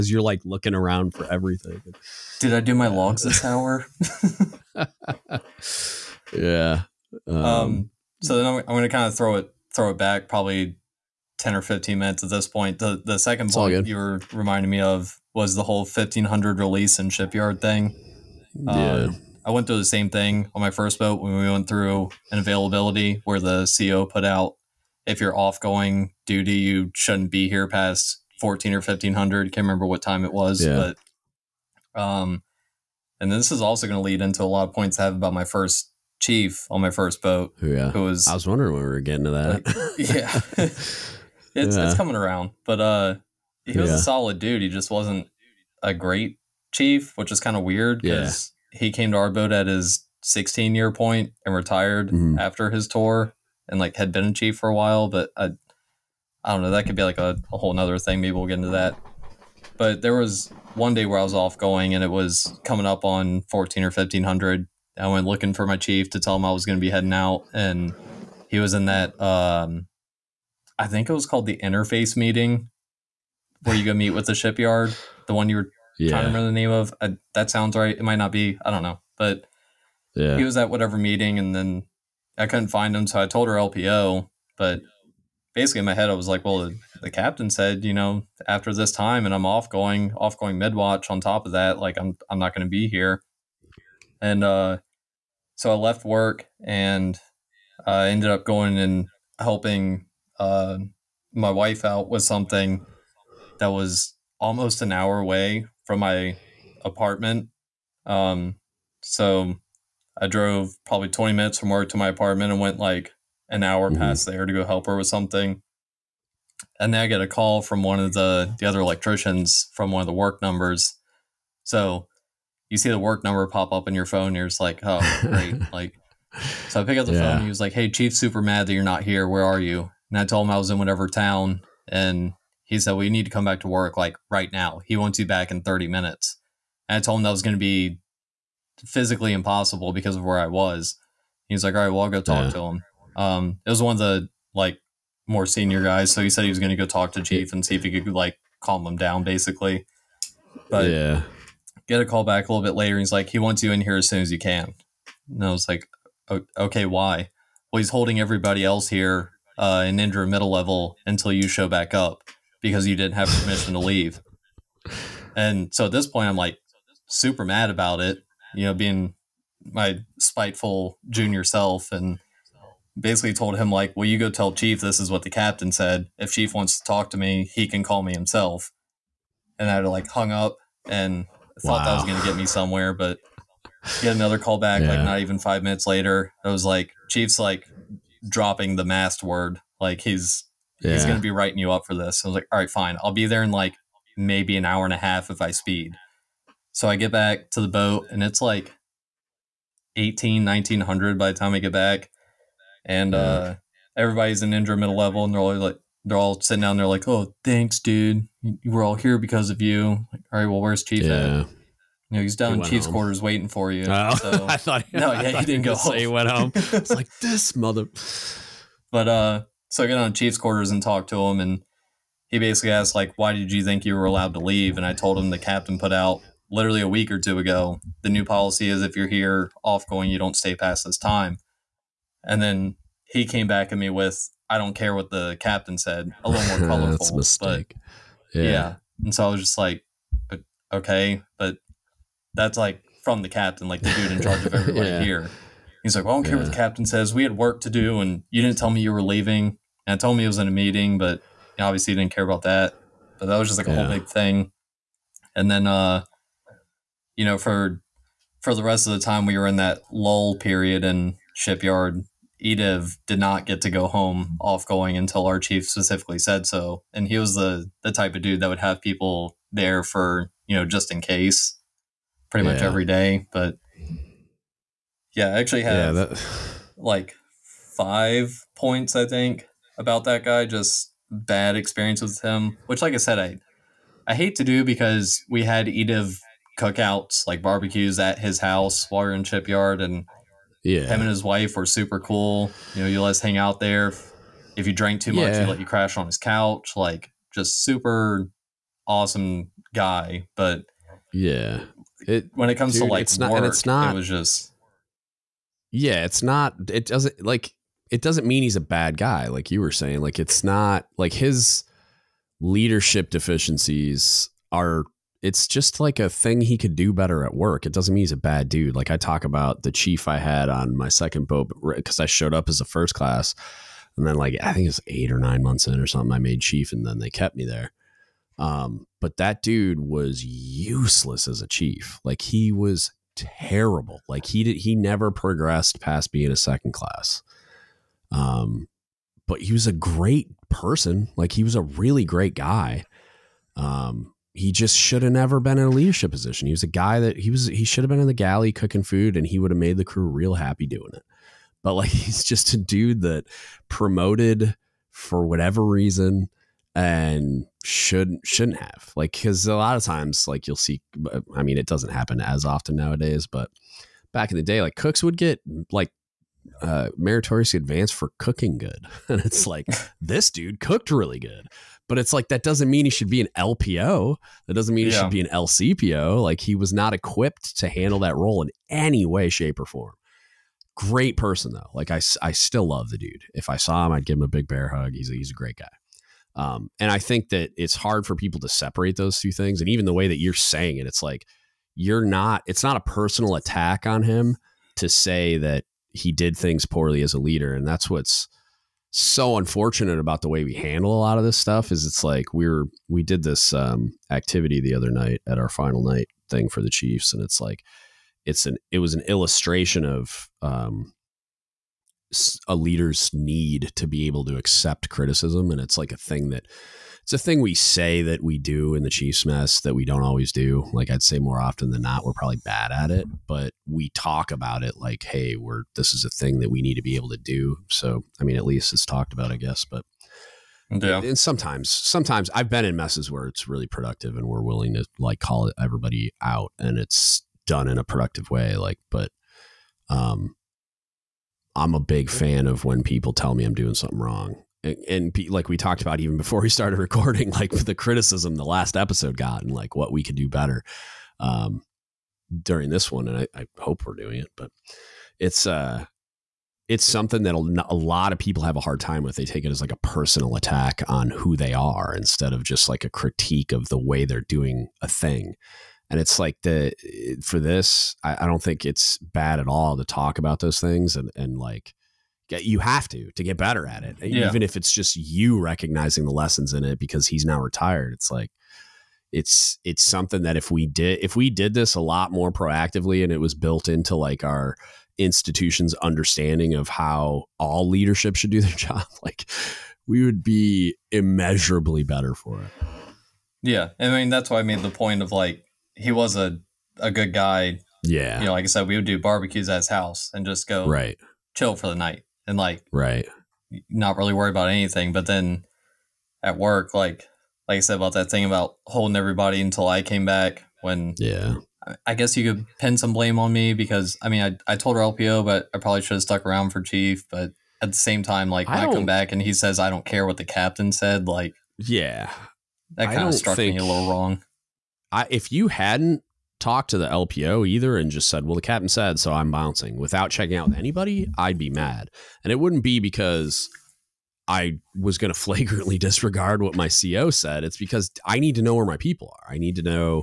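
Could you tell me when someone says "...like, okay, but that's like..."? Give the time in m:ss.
3:59.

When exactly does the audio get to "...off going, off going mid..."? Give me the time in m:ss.
1:29.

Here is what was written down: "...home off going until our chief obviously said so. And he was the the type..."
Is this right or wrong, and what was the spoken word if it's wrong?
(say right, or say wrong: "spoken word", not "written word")
wrong: "specifically", not "obviously".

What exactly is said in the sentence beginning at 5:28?
Um, but that dude was useless as a chief.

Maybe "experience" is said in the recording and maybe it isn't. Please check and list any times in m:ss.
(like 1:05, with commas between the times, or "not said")
4:41.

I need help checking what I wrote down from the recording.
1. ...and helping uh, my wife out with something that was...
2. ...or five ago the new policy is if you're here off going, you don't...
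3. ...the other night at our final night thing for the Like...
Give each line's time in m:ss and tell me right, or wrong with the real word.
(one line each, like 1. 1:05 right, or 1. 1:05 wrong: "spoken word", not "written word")
1. 1:38 right
2. 3:47 wrong: "two", not "five"
3. 6:44 wrong: "Chiefs", not "Like".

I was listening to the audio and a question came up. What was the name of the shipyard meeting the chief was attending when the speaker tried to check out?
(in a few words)
interface meeting.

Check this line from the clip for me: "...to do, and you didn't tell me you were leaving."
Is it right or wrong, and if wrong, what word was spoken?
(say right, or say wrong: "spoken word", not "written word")
right.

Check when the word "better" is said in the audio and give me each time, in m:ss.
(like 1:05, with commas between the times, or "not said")
5:16, 7:30, 7:53, 8:11.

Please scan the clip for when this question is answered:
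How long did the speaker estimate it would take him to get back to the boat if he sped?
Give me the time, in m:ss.
3:14.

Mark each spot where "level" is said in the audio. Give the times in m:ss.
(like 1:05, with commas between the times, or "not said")
2:40, 3:24.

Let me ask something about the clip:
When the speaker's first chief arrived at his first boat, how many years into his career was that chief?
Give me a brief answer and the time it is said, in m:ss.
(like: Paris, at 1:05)
16 years, at 0:50.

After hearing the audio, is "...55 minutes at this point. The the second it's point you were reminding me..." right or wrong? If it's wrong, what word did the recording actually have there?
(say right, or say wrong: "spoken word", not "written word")
wrong: "15", not "55".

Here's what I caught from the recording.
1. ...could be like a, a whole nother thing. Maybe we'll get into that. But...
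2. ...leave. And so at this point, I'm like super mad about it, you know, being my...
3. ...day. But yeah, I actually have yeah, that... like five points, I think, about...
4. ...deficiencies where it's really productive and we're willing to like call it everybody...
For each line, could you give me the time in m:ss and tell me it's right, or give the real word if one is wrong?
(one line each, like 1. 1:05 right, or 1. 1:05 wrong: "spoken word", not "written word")
1. 0:56 right
2. 2:43 right
3. 4:32 right
4. 7:12 wrong: "messes", not "deficiencies".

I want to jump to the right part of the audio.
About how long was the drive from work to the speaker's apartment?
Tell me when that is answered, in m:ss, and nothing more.
1:51.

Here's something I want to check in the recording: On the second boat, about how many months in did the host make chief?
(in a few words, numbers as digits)
8 or 9.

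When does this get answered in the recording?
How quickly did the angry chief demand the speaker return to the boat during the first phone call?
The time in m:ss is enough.
2:15.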